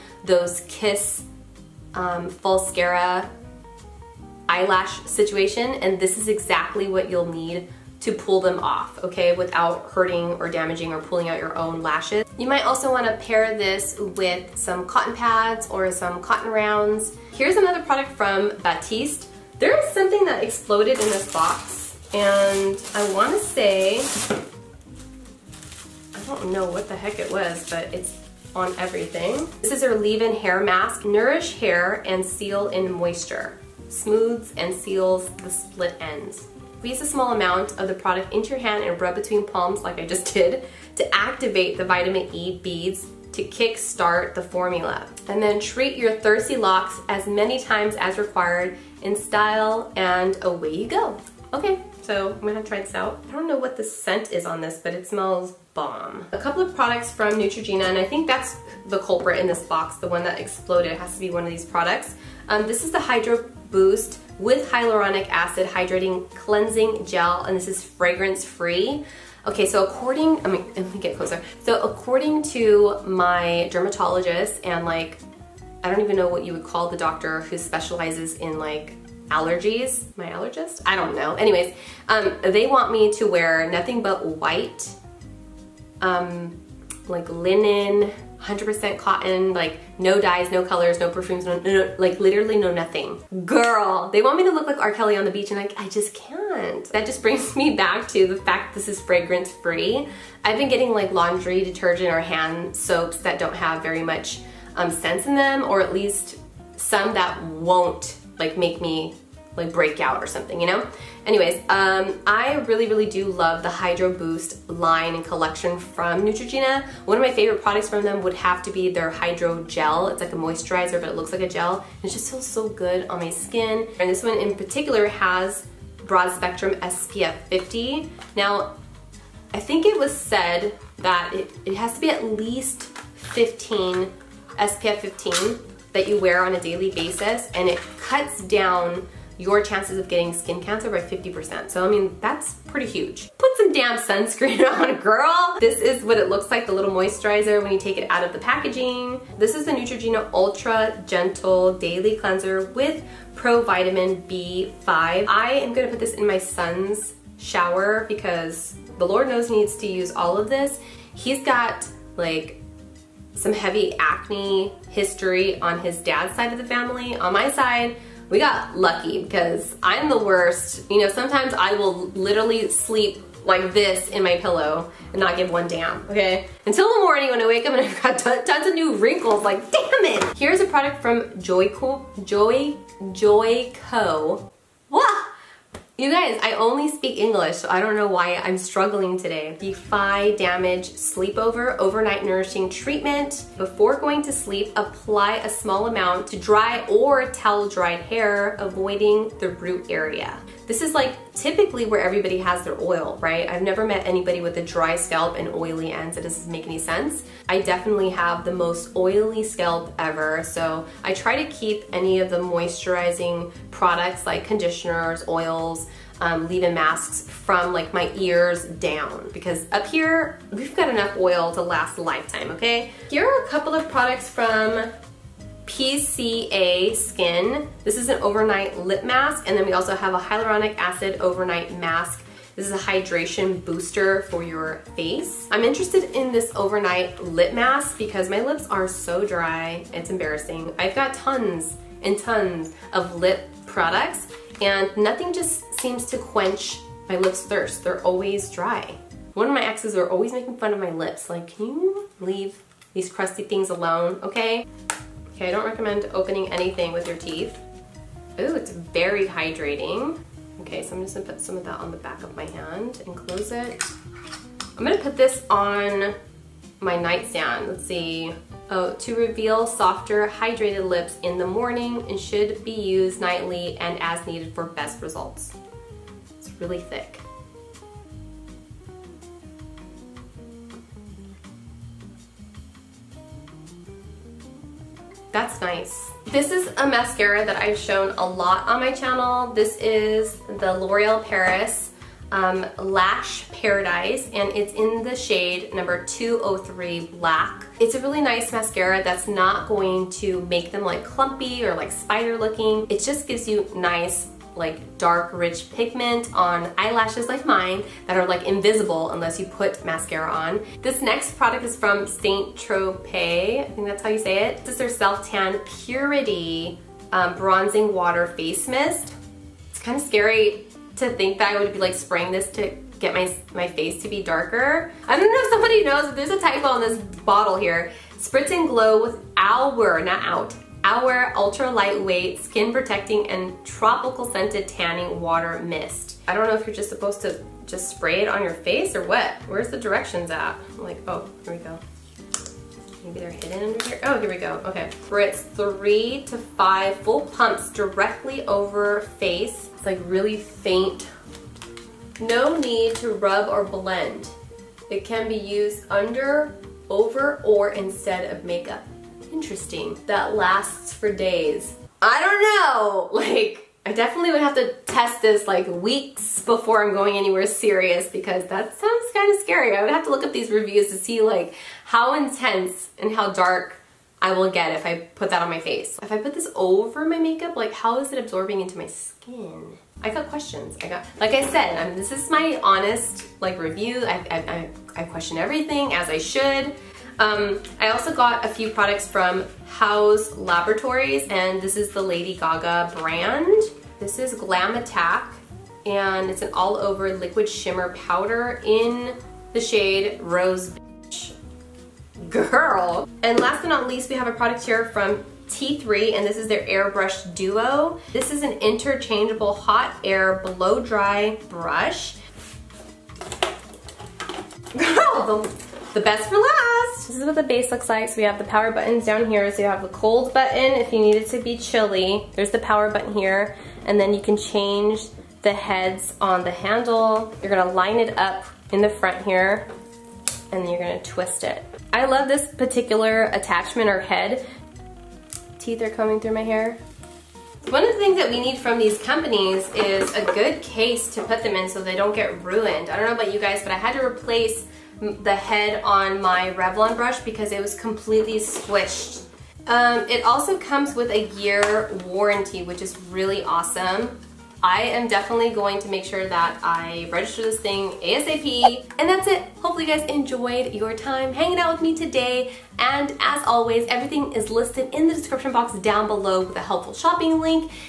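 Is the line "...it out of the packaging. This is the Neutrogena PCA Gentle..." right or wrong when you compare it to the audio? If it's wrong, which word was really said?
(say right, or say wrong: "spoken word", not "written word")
wrong: "Ultra", not "PCA".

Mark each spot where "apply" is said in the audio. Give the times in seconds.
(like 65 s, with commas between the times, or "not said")
194 s.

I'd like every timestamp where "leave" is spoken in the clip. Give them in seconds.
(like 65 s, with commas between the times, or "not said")
29 s, 216 s, 252 s.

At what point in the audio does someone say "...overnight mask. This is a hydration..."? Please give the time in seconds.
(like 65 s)
231 s.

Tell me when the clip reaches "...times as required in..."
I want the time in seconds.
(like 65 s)
47 s.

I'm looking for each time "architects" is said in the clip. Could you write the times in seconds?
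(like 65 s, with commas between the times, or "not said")
not said.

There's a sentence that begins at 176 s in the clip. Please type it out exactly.
Until the morning when I wake up and I've got tons of new wrinkles, like damn it!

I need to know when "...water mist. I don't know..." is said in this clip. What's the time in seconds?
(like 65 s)
335 s.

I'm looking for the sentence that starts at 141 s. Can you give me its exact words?
So I mean, that's pretty huge.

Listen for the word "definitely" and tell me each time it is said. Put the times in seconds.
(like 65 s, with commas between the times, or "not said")
207 s, 363 s, 455 s.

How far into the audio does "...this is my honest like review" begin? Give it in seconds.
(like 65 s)
381 s.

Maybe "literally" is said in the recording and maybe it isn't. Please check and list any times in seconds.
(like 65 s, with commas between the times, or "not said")
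92 s, 172 s.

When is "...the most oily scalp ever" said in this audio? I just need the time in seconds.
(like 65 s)
208 s.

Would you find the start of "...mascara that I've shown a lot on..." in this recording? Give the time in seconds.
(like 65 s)
286 s.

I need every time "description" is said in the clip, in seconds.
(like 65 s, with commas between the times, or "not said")
465 s.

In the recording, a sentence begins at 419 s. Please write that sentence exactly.
So you have the cold button if you need it to be chilly.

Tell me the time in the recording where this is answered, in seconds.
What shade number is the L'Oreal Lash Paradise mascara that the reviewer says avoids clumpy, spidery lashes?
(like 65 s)
296 s.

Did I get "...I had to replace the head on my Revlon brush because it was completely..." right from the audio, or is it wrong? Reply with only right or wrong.
right.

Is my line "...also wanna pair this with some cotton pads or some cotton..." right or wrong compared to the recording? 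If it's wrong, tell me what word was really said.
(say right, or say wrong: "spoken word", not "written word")
right.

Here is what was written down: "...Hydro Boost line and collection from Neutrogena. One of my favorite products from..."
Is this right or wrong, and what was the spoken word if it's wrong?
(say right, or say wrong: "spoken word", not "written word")
right.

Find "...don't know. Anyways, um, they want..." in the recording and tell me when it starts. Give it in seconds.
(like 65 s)
80 s.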